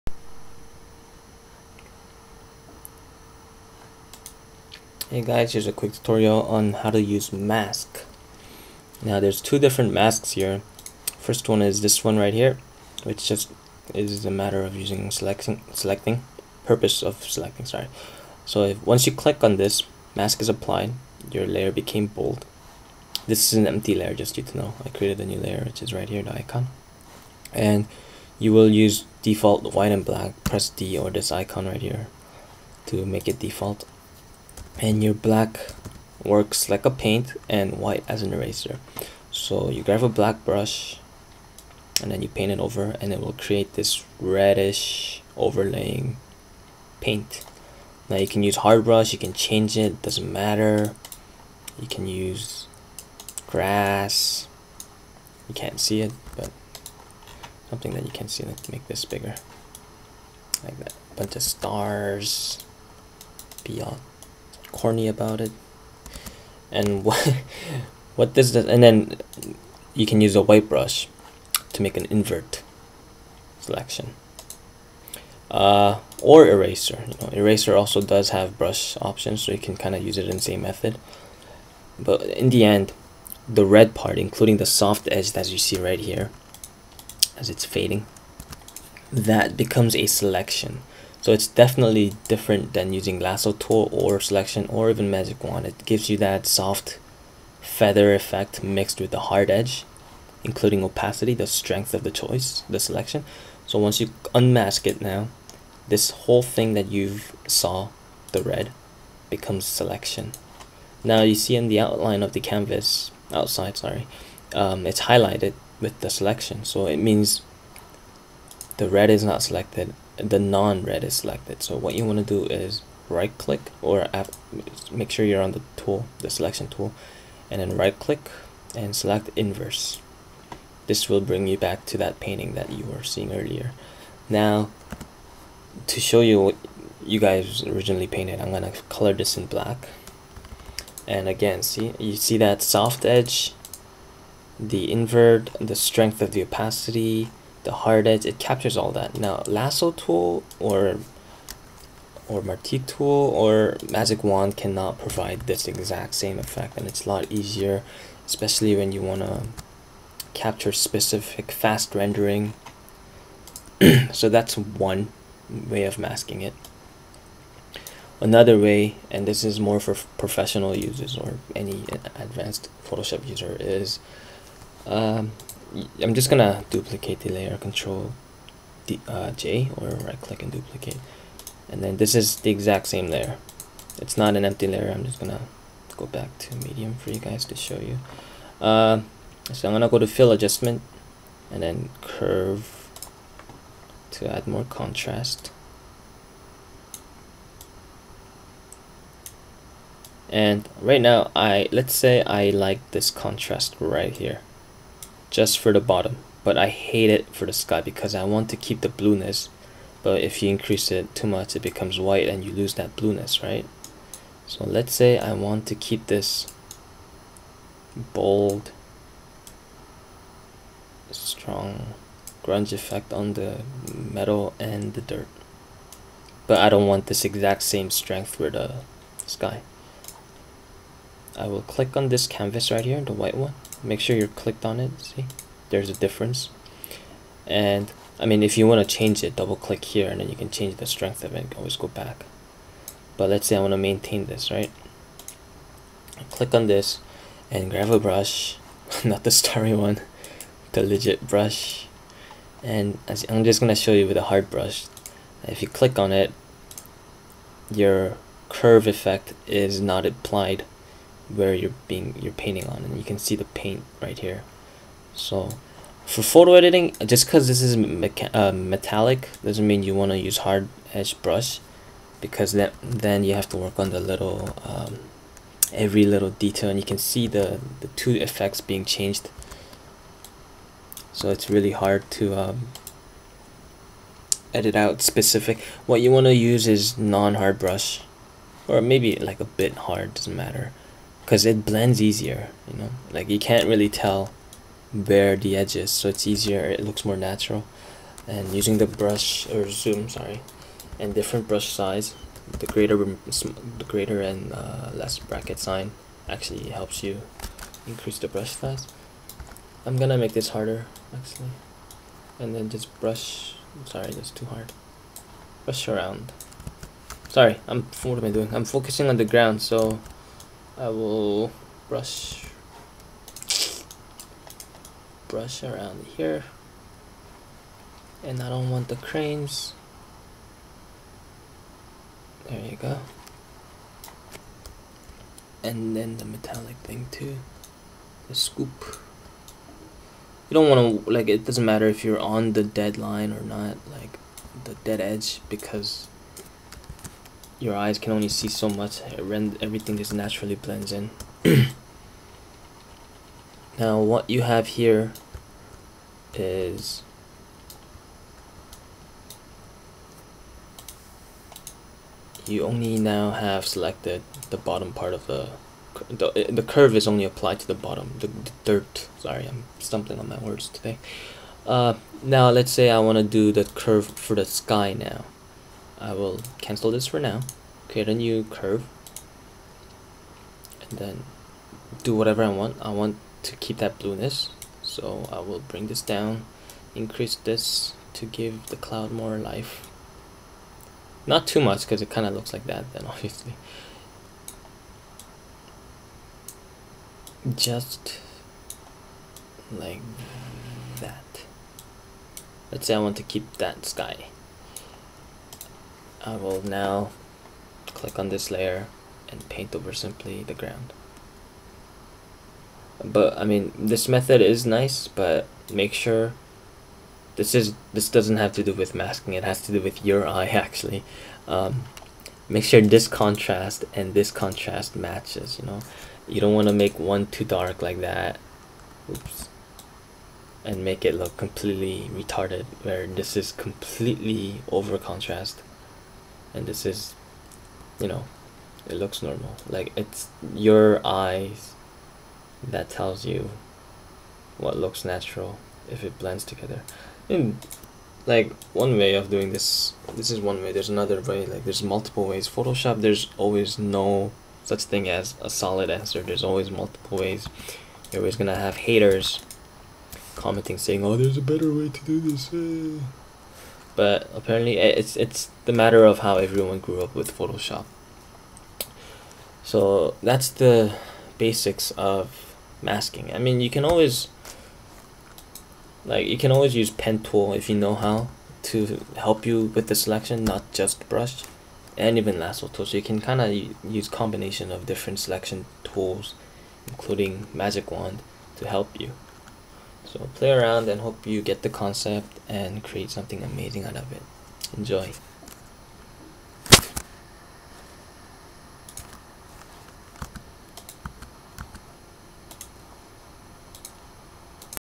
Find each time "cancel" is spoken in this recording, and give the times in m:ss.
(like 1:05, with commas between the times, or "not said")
6:16.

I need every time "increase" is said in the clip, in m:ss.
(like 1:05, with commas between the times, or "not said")
3:30, 5:07, 6:26.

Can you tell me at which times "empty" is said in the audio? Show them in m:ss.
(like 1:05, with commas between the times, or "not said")
0:23, 3:04.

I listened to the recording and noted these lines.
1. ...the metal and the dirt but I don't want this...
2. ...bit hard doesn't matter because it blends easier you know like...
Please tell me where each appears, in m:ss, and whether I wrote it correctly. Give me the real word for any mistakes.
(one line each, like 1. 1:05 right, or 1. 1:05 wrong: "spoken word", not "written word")
1. 3:43 right
2. 4:49 right.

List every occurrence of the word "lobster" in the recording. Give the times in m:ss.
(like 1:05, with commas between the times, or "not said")
not said.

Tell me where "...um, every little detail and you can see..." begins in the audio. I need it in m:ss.
4:34.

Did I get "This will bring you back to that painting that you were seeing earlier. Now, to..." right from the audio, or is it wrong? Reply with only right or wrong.
right.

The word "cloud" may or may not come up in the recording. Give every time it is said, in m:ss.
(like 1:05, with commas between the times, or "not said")
6:28.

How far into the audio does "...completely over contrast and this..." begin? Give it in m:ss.
7:13.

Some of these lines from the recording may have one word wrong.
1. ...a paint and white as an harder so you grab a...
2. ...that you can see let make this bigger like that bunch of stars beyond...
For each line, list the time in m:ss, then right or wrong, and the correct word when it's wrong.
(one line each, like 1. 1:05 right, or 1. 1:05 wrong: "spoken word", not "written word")
1. 0:36 wrong: "eraser", not "harder"
2. 0:57 right.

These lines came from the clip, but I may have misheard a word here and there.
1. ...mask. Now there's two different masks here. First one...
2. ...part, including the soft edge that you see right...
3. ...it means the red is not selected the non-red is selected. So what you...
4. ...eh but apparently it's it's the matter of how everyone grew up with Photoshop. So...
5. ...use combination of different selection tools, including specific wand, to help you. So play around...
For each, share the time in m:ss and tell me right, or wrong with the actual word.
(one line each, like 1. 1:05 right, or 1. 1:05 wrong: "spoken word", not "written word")
1. 0:07 right
2. 1:23 right
3. 1:56 right
4. 7:42 right
5. 8:03 wrong: "magic", not "specific".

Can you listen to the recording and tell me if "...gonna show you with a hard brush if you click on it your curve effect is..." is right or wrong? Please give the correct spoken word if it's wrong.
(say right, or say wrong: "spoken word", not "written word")
right.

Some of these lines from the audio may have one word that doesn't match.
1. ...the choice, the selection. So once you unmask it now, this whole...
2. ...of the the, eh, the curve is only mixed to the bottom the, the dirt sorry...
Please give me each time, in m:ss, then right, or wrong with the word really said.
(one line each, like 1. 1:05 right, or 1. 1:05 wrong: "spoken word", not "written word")
1. 1:42 right
2. 6:05 wrong: "applied", not "mixed".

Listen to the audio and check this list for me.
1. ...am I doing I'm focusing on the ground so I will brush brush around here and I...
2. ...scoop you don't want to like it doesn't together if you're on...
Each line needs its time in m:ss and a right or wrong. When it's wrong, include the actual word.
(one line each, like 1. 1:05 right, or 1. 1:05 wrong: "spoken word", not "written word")
1. 5:18 right
2. 5:38 wrong: "matter", not "together".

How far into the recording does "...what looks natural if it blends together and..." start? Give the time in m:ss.
7:24.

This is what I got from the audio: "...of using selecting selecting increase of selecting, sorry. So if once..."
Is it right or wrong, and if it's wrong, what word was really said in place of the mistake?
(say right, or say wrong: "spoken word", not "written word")
wrong: "purpose", not "increase".